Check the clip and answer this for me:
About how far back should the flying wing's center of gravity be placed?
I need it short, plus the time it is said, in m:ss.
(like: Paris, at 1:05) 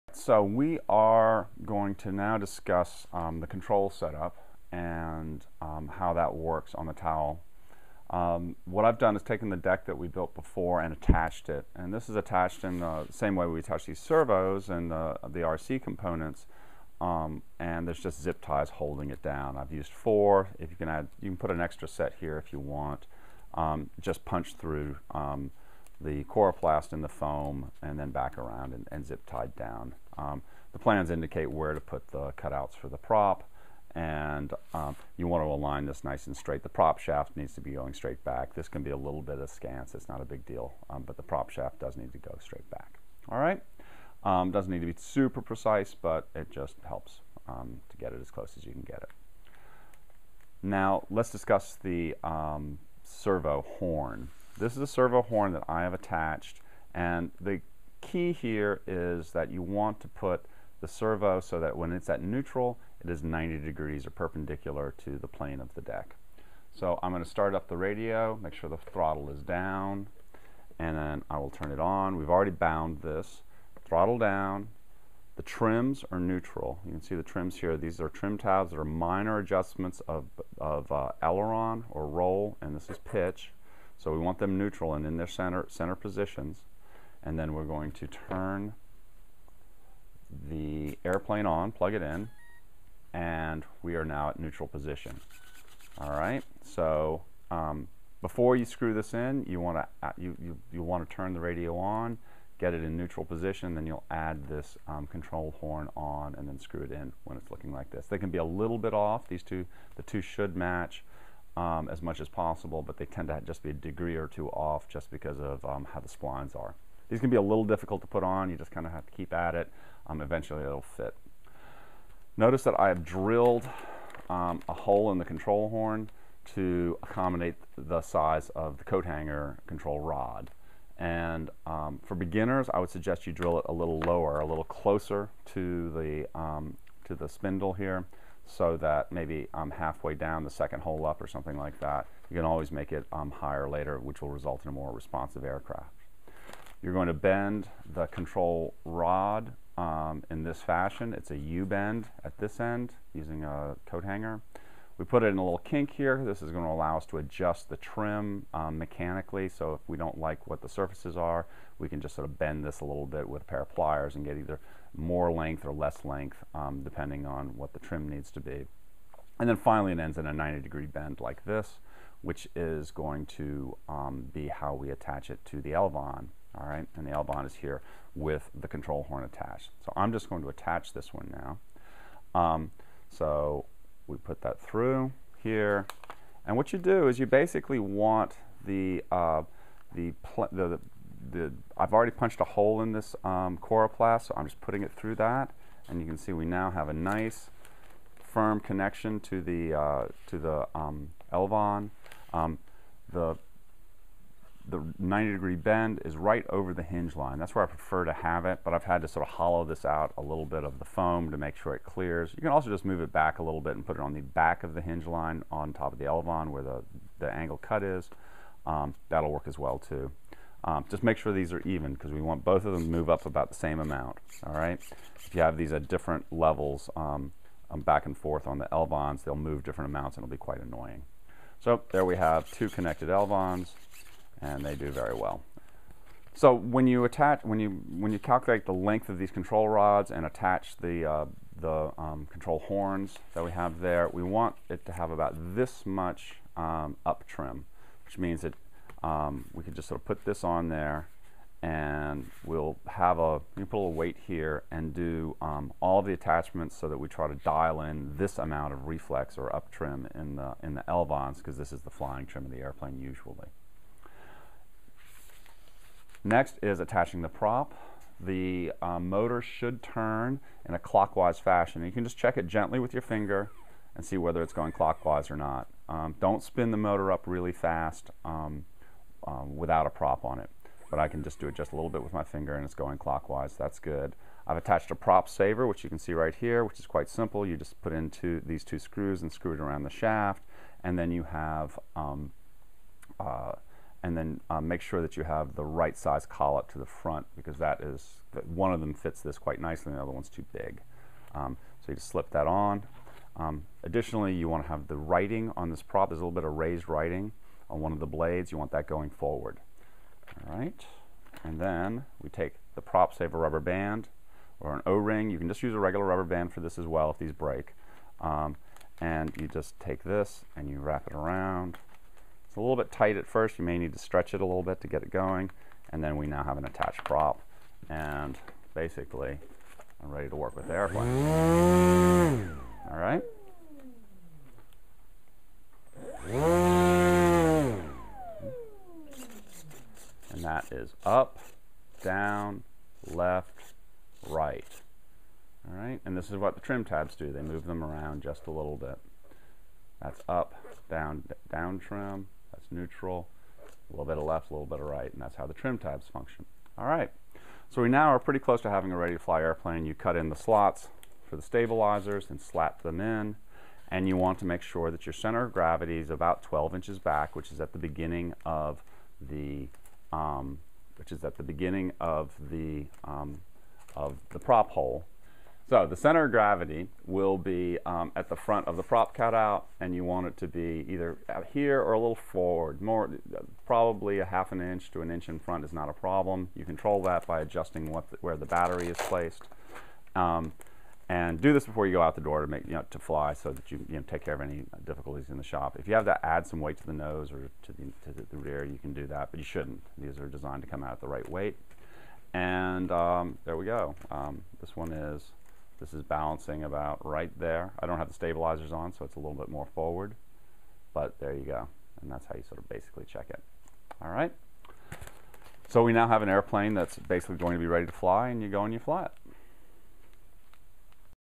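12 inches, at 6:06.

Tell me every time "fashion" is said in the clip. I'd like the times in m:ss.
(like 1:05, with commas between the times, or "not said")
2:30, 4:31.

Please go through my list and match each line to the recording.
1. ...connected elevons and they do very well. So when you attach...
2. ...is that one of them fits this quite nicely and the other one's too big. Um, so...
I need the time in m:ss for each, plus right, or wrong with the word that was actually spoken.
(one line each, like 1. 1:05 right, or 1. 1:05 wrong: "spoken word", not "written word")
1. 3:52 right
2. 4:57 right.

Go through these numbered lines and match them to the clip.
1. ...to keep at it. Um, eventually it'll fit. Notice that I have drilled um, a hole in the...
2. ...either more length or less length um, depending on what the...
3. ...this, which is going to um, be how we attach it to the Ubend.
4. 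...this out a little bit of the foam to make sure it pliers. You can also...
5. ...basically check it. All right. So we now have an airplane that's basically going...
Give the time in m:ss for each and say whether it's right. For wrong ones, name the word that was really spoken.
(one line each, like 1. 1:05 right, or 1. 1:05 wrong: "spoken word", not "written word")
1. 1:59 right
2. 2:44 right
3. 2:51 wrong: "Elevon", not "Ubend"
4. 3:29 wrong: "clears", not "pliers"
5. 6:52 right.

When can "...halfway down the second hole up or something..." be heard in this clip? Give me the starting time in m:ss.
2:19.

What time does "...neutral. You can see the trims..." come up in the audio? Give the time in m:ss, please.
1:16.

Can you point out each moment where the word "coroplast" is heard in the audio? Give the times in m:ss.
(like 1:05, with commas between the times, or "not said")
0:26, 3:13.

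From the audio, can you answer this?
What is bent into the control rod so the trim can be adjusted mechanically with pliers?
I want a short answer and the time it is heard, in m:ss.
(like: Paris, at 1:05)
A little kink, at 2:35.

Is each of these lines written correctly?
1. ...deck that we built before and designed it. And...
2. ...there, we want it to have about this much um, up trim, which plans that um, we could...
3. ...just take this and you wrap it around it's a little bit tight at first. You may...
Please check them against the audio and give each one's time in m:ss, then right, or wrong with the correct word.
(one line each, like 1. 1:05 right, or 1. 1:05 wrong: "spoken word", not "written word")
1. 0:09 wrong: "attached", not "designed"
2. 4:03 wrong: "means", not "plans"
3. 5:19 right.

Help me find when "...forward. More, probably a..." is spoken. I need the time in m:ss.
6:22.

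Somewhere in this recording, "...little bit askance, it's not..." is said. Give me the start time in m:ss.
0:38.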